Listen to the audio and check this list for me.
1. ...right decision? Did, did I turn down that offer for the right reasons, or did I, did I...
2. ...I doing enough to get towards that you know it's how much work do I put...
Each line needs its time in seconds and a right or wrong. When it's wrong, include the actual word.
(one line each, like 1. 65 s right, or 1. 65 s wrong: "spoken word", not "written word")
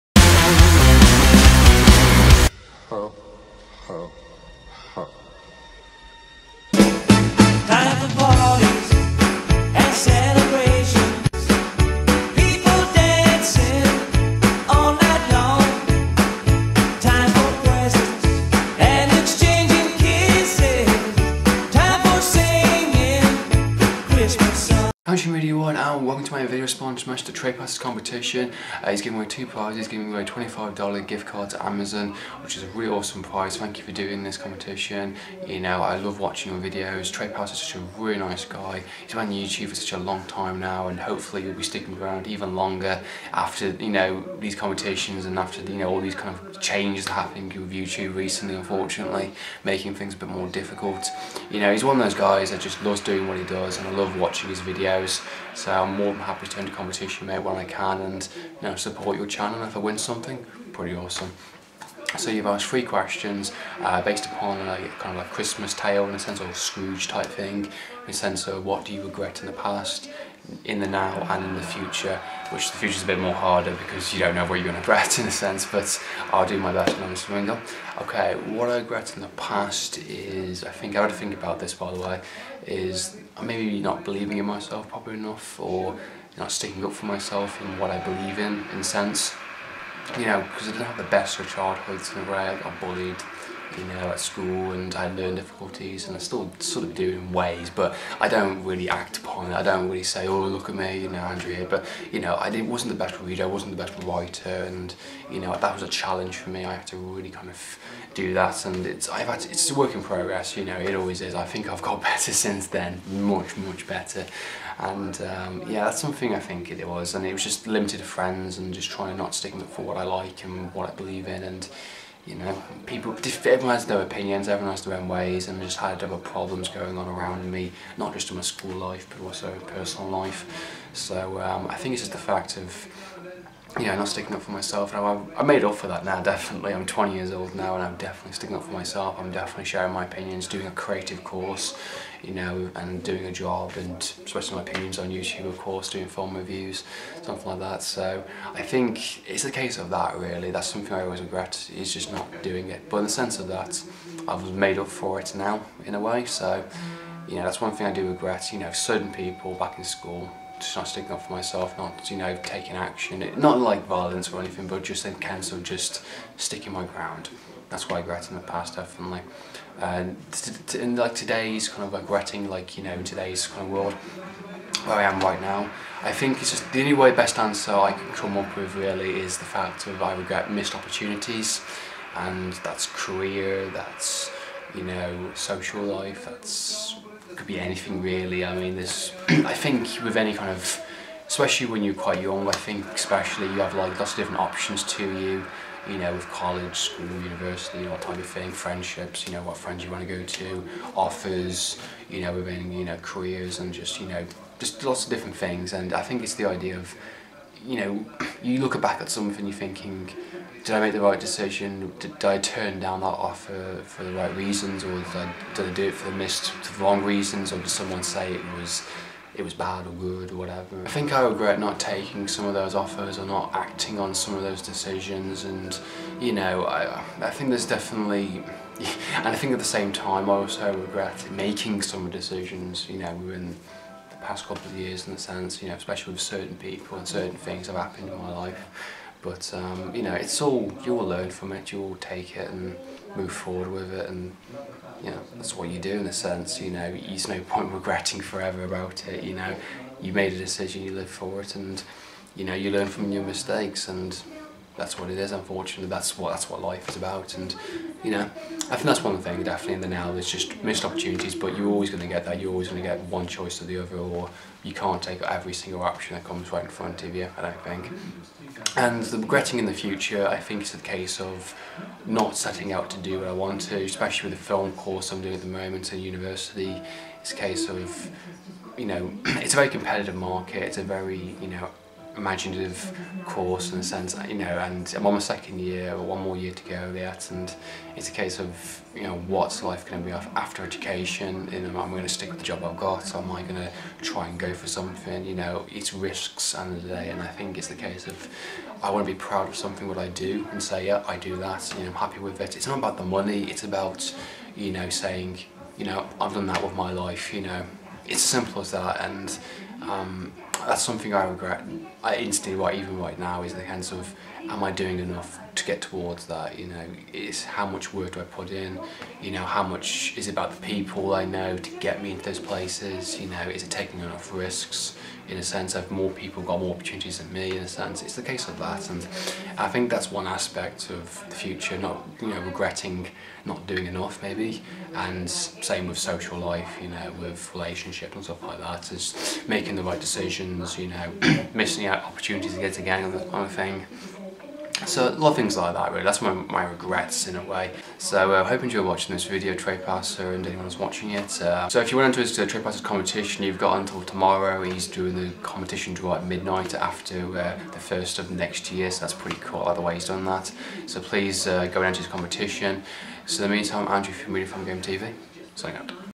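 1. 211 s right
2. 314 s right.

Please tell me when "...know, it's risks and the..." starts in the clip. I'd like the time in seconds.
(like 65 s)
295 s.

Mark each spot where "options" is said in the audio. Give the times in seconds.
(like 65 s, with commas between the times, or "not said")
194 s, 265 s.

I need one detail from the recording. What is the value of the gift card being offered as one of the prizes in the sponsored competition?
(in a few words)
$25.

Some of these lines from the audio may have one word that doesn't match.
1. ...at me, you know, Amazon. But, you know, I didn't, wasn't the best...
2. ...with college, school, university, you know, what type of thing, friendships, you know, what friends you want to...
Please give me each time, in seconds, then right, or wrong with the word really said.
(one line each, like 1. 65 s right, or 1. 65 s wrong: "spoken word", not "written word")
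1. 100 s wrong: "Andrea", not "Amazon"
2. 196 s right.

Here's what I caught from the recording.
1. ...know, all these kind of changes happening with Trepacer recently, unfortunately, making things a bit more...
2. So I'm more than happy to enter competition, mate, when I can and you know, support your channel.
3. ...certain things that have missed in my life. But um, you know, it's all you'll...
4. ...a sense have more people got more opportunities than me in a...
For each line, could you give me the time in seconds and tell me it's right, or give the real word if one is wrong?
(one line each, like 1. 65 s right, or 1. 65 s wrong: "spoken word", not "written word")
1. 45 s wrong: "YouTube", not "Trepacer"
2. 55 s right
3. 237 s wrong: "happened", not "missed"
4. 325 s right.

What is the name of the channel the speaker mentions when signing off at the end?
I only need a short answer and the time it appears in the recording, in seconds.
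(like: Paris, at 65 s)
Really Fun Game TV, at 364 s.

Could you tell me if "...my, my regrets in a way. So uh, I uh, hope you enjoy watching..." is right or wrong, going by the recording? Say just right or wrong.
right.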